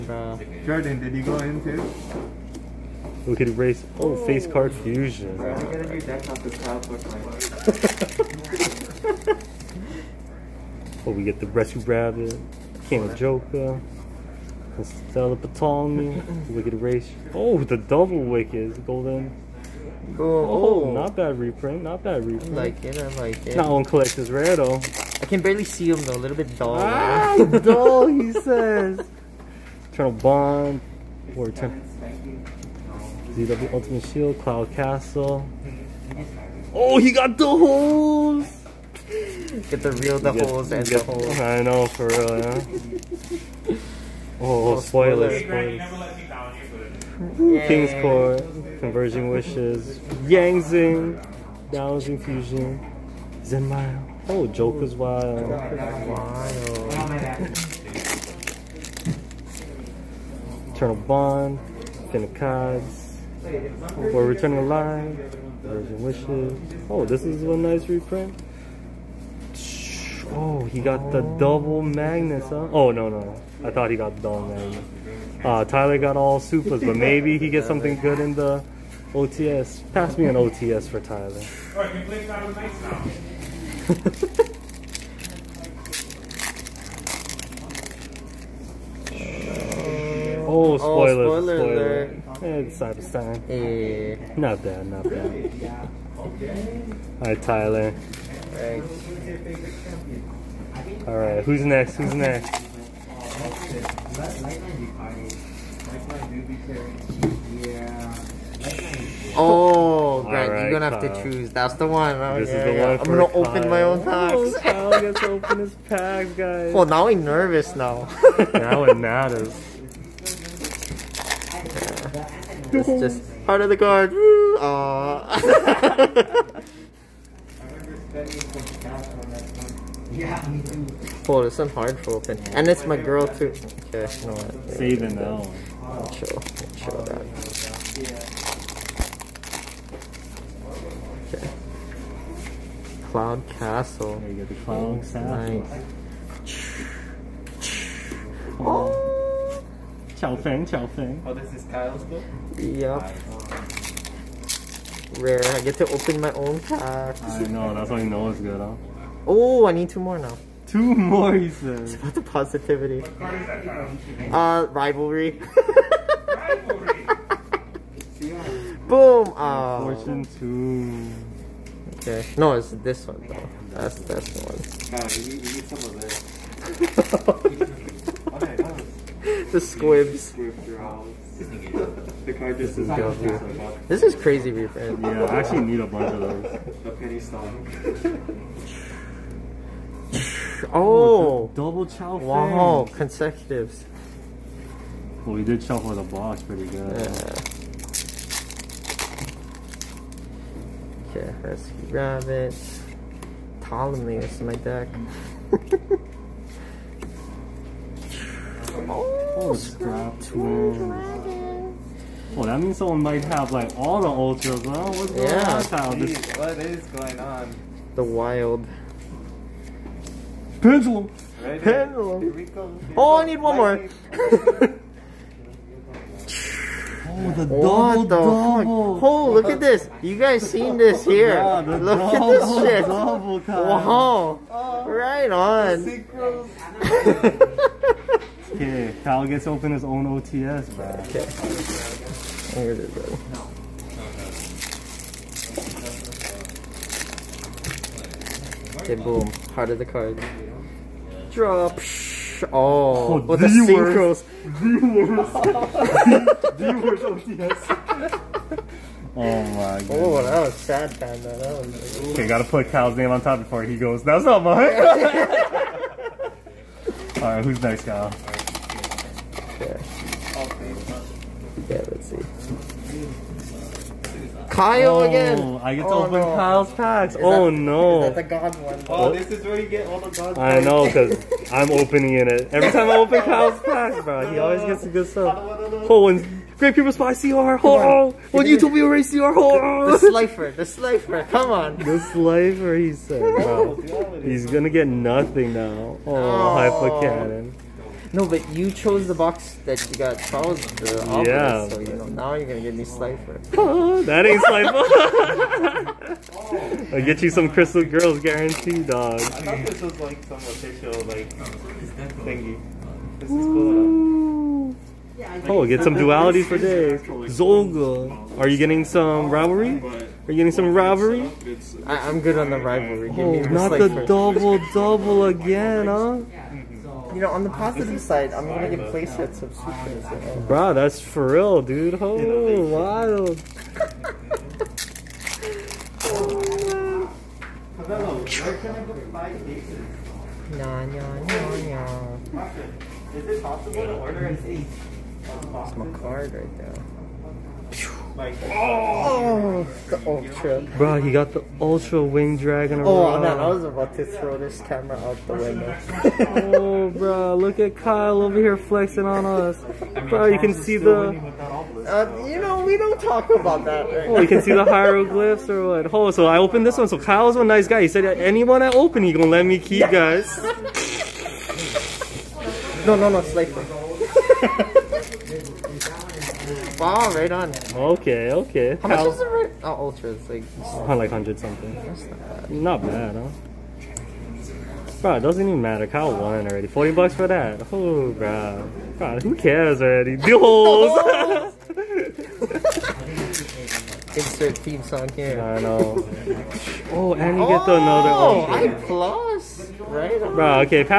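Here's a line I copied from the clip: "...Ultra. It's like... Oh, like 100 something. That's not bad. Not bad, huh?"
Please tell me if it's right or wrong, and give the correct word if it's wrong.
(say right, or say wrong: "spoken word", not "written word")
right.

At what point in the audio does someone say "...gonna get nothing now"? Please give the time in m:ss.
4:54.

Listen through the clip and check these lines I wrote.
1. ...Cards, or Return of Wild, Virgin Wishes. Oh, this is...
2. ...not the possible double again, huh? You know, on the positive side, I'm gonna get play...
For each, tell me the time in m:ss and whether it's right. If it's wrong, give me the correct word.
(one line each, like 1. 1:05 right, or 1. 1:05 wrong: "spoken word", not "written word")
1. 1:02 wrong: "Line", not "Wild"
2. 5:23 wrong: "double", not "possible".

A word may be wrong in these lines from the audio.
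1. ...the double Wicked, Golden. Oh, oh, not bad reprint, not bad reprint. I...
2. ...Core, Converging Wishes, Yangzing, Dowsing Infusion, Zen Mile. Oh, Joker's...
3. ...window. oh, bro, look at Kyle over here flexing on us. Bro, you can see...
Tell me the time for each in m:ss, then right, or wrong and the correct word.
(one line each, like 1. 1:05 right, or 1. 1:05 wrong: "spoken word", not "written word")
1. 0:17 right
2. 0:48 right
3. 5:55 right.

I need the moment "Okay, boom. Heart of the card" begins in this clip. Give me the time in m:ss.
4:08.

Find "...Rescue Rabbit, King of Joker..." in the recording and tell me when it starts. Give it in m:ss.
0:11.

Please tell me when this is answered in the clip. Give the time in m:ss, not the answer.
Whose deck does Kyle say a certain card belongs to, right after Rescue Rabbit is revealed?
3:23.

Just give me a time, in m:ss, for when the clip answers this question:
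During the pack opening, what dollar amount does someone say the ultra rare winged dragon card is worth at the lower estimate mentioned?
6:26.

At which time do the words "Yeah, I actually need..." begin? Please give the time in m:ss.
3:04.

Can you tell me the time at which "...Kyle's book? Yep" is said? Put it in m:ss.
2:31.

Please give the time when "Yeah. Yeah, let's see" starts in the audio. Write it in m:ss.
4:29.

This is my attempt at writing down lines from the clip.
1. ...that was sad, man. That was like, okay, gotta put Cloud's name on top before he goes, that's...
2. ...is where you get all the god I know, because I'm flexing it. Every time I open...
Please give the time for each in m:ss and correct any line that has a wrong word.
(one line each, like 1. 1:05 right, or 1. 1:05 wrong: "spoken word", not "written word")
1. 4:20 wrong: "Kyle", not "Cloud"
2. 4:39 wrong: "opening", not "flexing".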